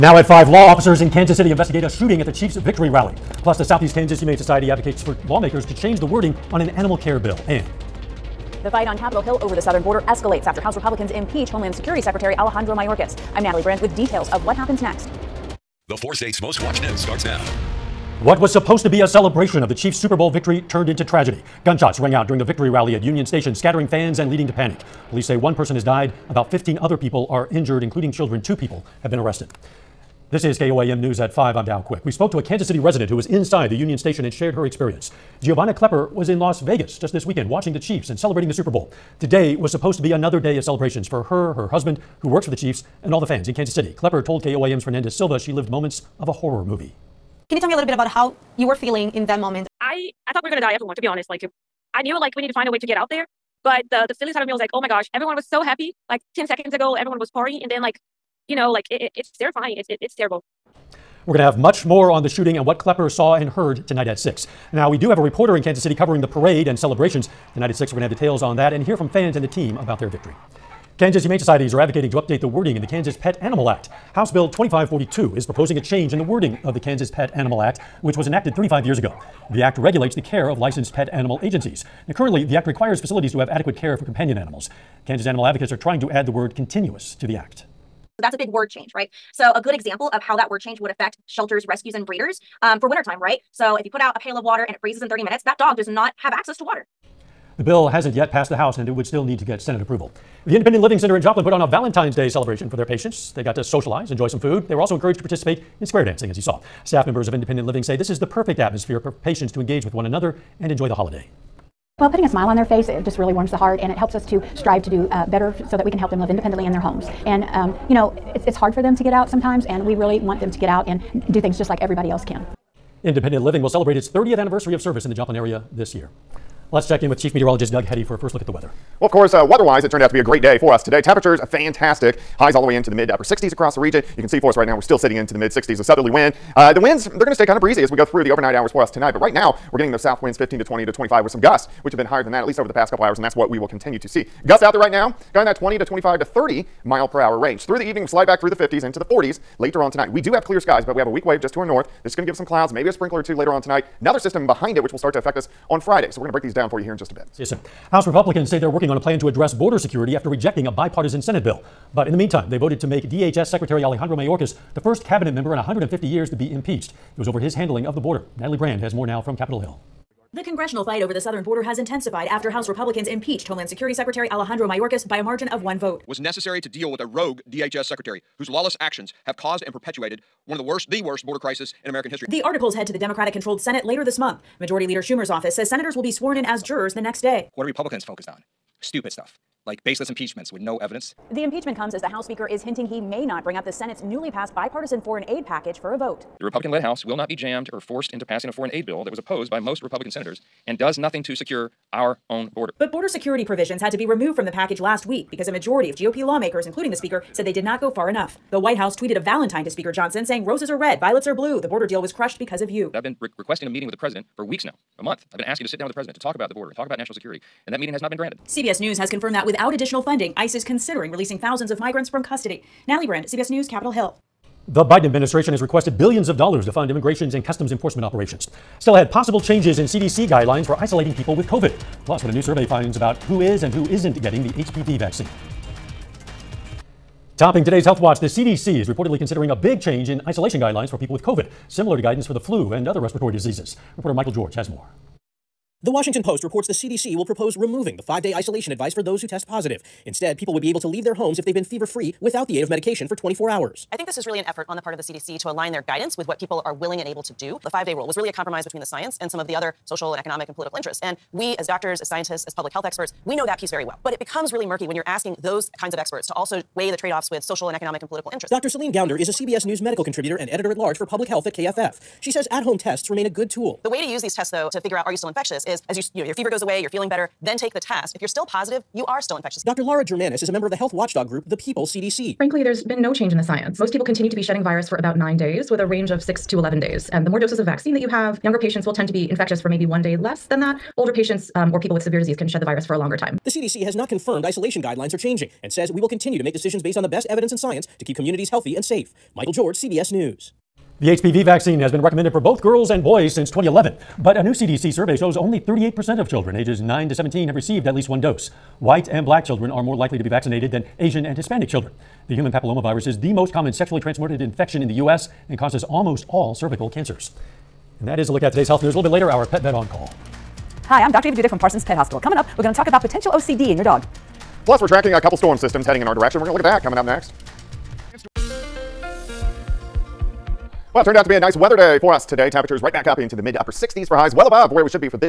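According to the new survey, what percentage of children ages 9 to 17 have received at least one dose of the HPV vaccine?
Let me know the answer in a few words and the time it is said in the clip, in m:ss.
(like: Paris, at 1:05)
38%, at 5:05.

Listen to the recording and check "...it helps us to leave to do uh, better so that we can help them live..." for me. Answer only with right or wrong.
wrong.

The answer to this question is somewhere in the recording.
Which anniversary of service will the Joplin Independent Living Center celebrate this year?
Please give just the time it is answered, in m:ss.
2:04.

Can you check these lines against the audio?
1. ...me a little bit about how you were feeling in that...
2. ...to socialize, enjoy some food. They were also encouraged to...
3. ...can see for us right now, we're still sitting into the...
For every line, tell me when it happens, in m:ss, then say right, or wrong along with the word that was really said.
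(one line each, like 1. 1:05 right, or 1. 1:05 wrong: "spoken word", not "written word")
1. 0:47 right
2. 1:43 right
3. 2:14 right.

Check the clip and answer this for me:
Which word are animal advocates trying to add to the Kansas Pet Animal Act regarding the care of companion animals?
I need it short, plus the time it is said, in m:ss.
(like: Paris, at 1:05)
continuous, at 1:26.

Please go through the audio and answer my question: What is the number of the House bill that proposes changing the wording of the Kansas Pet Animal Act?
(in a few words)
2542.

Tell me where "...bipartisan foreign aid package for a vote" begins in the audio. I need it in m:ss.
3:14.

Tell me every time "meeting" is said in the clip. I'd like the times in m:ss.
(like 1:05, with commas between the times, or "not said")
3:33, 3:37.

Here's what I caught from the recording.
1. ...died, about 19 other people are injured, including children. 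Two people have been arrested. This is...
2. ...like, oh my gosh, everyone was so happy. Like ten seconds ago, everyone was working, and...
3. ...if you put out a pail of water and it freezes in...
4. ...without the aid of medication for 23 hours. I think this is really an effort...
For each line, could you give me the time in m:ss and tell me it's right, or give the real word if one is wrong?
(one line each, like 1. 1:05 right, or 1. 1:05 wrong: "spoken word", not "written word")
1. 0:25 wrong: "15", not "19"
2. 0:54 wrong: "partying", not "working"
3. 1:33 right
4. 4:12 wrong: "24", not "23".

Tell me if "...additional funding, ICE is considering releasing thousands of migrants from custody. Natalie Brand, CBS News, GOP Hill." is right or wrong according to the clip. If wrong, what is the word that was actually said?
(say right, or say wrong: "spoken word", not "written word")
wrong: "Capitol", not "GOP".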